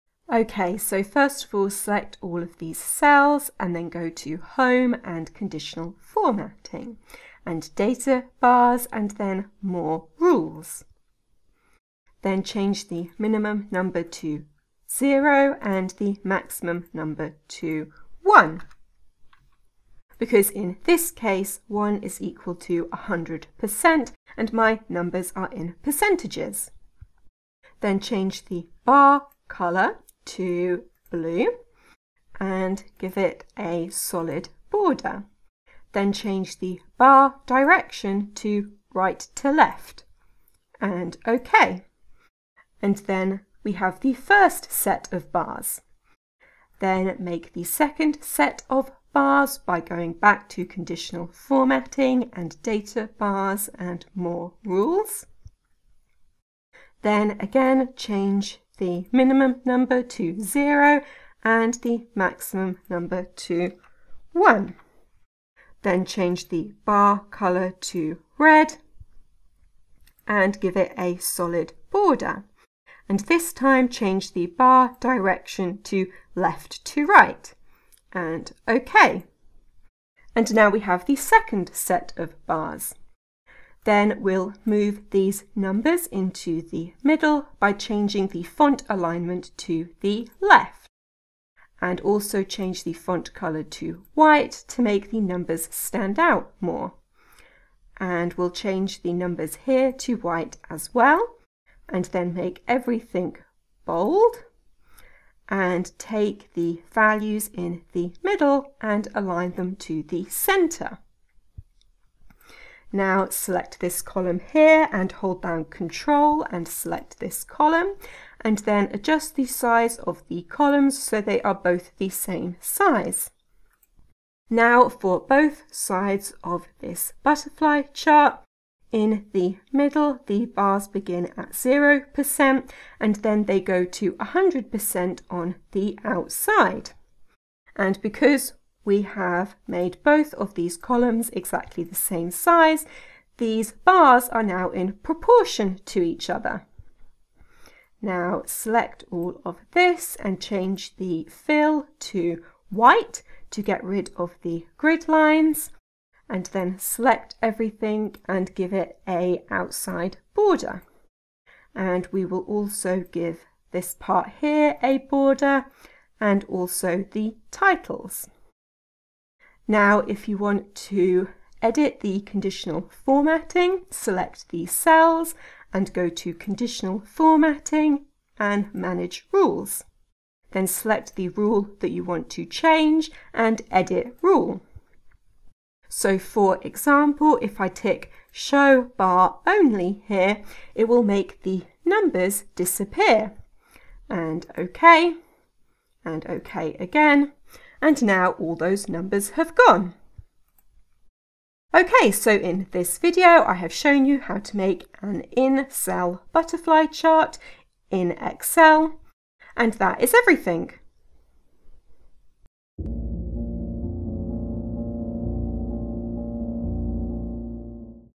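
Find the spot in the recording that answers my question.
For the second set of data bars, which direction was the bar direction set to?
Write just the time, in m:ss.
1:16.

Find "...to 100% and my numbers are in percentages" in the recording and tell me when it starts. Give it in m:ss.
0:22.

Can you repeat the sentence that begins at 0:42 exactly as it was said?
And then we have the first set of bars.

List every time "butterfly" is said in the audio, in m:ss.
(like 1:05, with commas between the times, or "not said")
2:07, 3:26.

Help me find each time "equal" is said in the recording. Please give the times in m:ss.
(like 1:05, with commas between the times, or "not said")
0:22.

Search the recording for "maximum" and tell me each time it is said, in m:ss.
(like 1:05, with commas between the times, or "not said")
0:16, 1:02.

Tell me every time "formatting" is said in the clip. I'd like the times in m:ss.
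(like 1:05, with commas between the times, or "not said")
0:05, 0:51, 2:52, 2:57.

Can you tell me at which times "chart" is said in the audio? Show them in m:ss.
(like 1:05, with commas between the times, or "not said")
2:07, 3:26.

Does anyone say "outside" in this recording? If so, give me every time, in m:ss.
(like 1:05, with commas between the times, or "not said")
2:16, 2:39.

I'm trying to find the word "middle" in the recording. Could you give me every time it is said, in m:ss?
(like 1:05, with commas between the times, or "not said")
1:27, 1:48, 2:09.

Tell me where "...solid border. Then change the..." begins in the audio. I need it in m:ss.
0:33.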